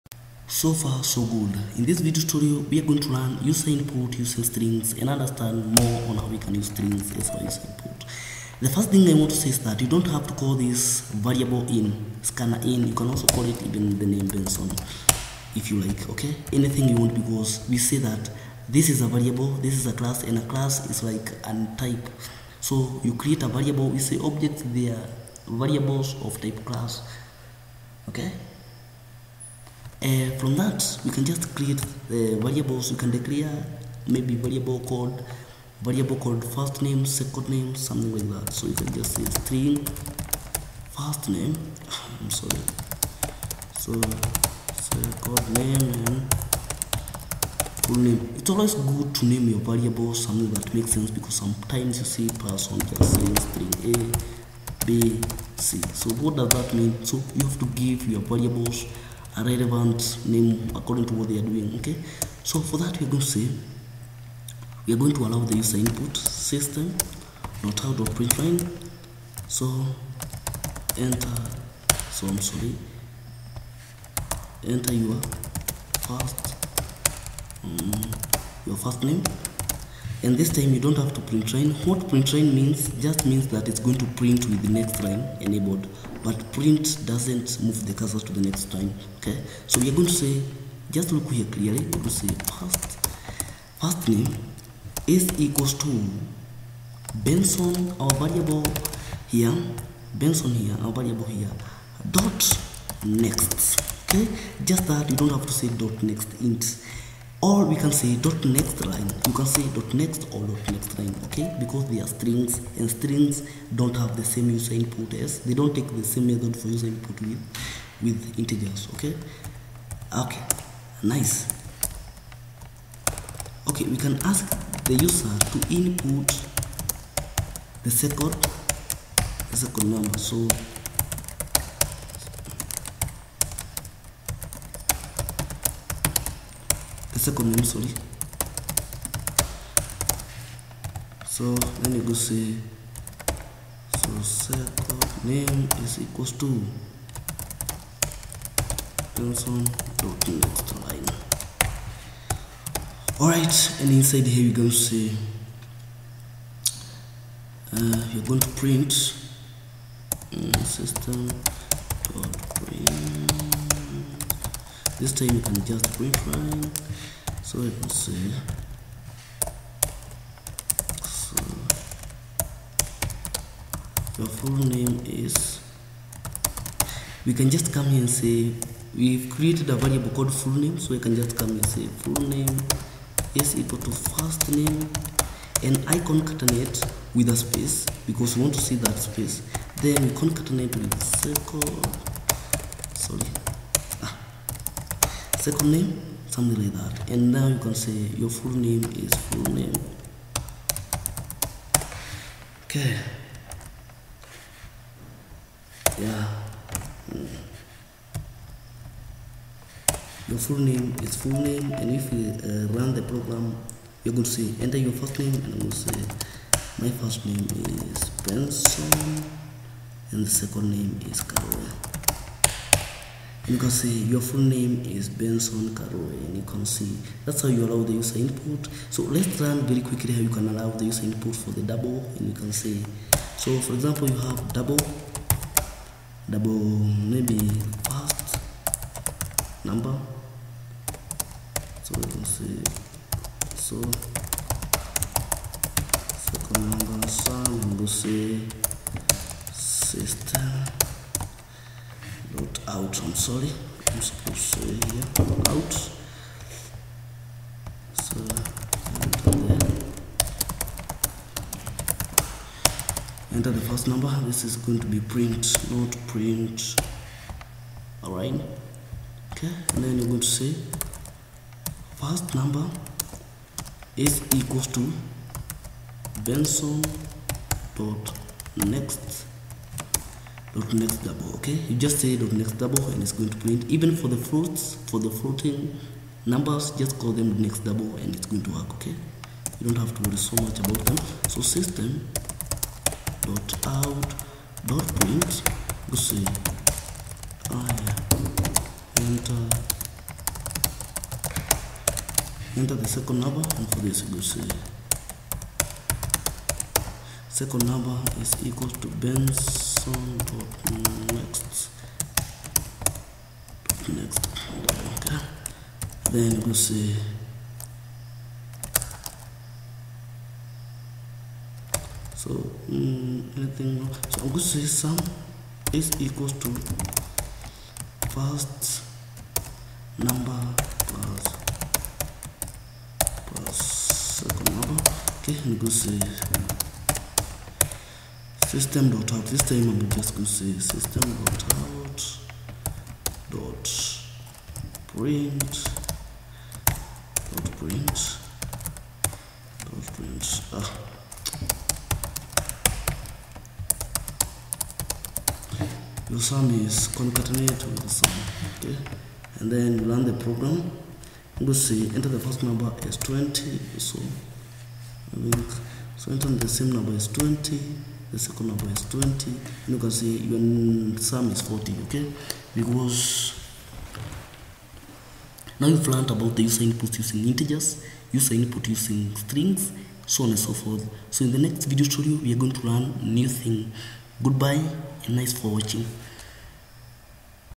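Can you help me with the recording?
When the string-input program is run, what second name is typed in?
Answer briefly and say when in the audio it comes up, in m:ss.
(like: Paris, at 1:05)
Carol, at 3:41.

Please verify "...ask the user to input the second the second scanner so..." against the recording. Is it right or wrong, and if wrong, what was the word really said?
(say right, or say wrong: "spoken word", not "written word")
wrong: "number", not "scanner".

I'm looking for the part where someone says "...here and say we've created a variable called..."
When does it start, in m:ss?
2:57.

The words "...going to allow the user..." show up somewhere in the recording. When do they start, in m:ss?
1:04.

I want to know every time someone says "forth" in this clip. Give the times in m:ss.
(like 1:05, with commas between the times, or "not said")
6:20.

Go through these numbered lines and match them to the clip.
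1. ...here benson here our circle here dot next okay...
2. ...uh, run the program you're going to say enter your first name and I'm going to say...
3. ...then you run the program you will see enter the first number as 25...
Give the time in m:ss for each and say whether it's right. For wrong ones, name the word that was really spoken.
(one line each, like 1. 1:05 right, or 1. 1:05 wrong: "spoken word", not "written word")
1. 1:39 wrong: "variable", not "circle"
2. 3:32 right
3. 5:59 wrong: "20", not "25".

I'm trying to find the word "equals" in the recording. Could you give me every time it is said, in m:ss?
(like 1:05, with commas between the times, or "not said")
1:35, 2:26, 3:03, 4:34, 5:08, 5:25.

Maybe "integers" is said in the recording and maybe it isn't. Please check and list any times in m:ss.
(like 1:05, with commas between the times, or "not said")
1:58, 6:17.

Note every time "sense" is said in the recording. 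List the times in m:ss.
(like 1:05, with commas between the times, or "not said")
0:50.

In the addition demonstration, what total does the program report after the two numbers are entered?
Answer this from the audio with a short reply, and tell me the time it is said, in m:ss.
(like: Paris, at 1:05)
40, at 6:11.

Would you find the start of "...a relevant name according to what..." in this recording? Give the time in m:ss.
0:59.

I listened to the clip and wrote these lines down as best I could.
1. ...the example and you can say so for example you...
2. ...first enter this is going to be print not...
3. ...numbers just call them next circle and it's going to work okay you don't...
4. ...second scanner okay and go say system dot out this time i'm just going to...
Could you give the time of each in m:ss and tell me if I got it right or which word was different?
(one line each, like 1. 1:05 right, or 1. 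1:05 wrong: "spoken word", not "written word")
1. 3:51 wrong: "double", not "example"
2. 4:23 wrong: "number", not "enter"
3. 4:46 wrong: "double", not "circle"
4. 5:33 wrong: "number", not "scanner".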